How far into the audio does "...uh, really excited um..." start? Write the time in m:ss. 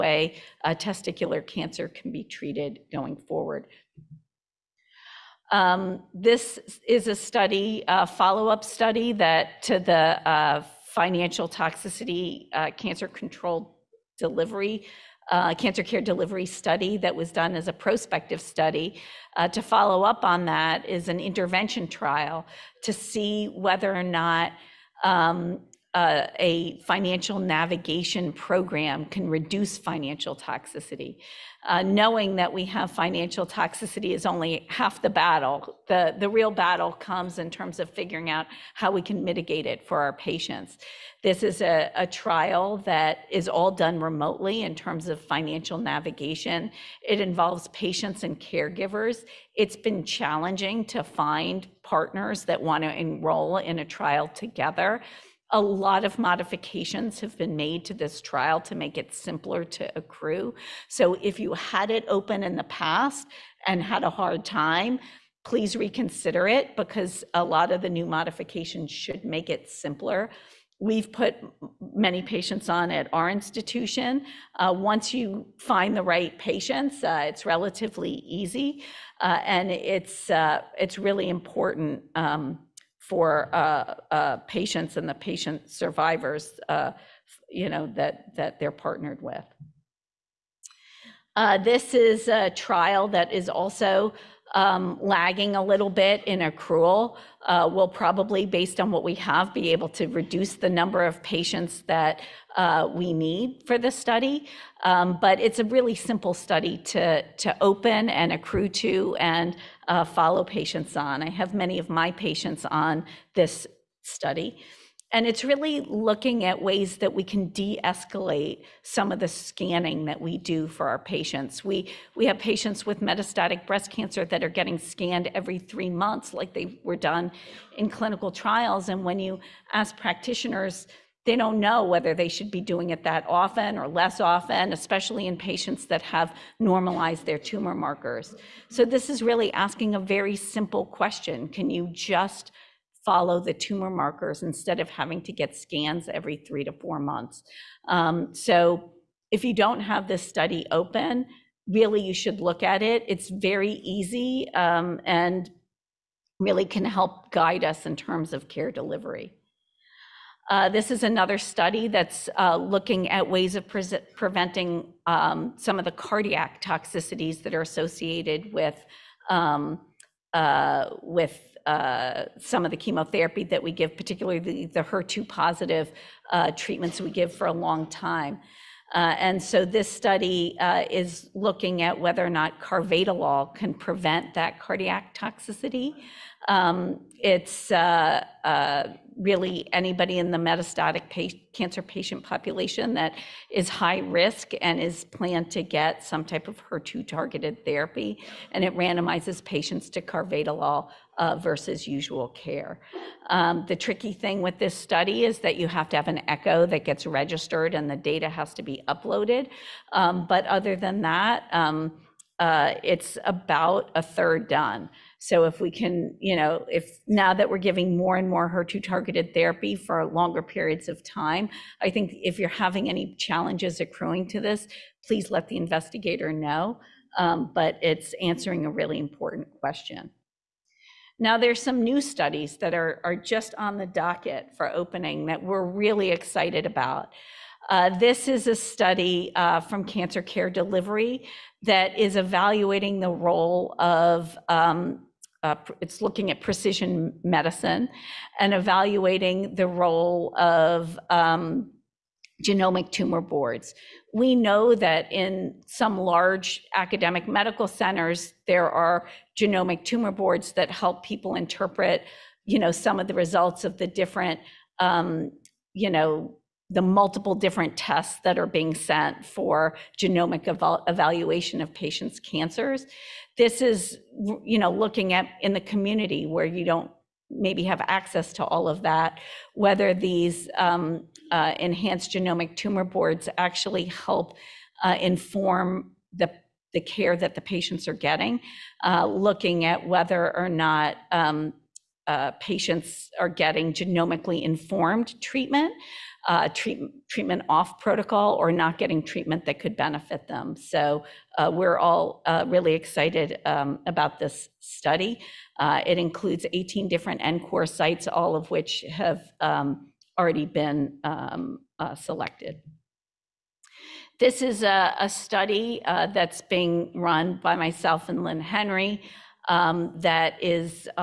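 5:02.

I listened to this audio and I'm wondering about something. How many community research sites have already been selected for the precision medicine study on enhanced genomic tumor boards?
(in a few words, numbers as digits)
18.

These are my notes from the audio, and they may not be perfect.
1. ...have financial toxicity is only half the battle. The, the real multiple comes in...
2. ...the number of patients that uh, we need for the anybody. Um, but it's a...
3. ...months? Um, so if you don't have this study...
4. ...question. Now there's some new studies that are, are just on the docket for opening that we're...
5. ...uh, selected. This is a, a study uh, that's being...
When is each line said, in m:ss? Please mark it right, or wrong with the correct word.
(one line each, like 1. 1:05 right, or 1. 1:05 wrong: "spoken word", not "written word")
1. 0:32 wrong: "battle", not "multiple"
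2. 1:40 wrong: "study", not "anybody"
3. 2:26 right
4. 3:49 right
5. 5:11 right.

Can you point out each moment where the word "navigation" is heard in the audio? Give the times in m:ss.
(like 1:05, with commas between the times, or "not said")
0:27, 0:45.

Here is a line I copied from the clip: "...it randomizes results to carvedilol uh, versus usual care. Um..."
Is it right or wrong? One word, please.
wrong.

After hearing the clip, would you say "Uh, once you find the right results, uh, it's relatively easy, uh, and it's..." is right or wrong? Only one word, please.
wrong.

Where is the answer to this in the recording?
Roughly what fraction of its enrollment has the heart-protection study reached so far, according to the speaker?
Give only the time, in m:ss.
3:33.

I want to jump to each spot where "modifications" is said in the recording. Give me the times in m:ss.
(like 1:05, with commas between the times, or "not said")
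0:56, 1:08.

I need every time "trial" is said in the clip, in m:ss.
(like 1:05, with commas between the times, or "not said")
0:21, 0:42, 0:53, 0:58, 1:32, 2:08.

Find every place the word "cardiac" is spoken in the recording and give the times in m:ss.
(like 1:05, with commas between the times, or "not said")
2:45, 3:04.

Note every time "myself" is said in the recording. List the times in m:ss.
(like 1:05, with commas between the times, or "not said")
5:17.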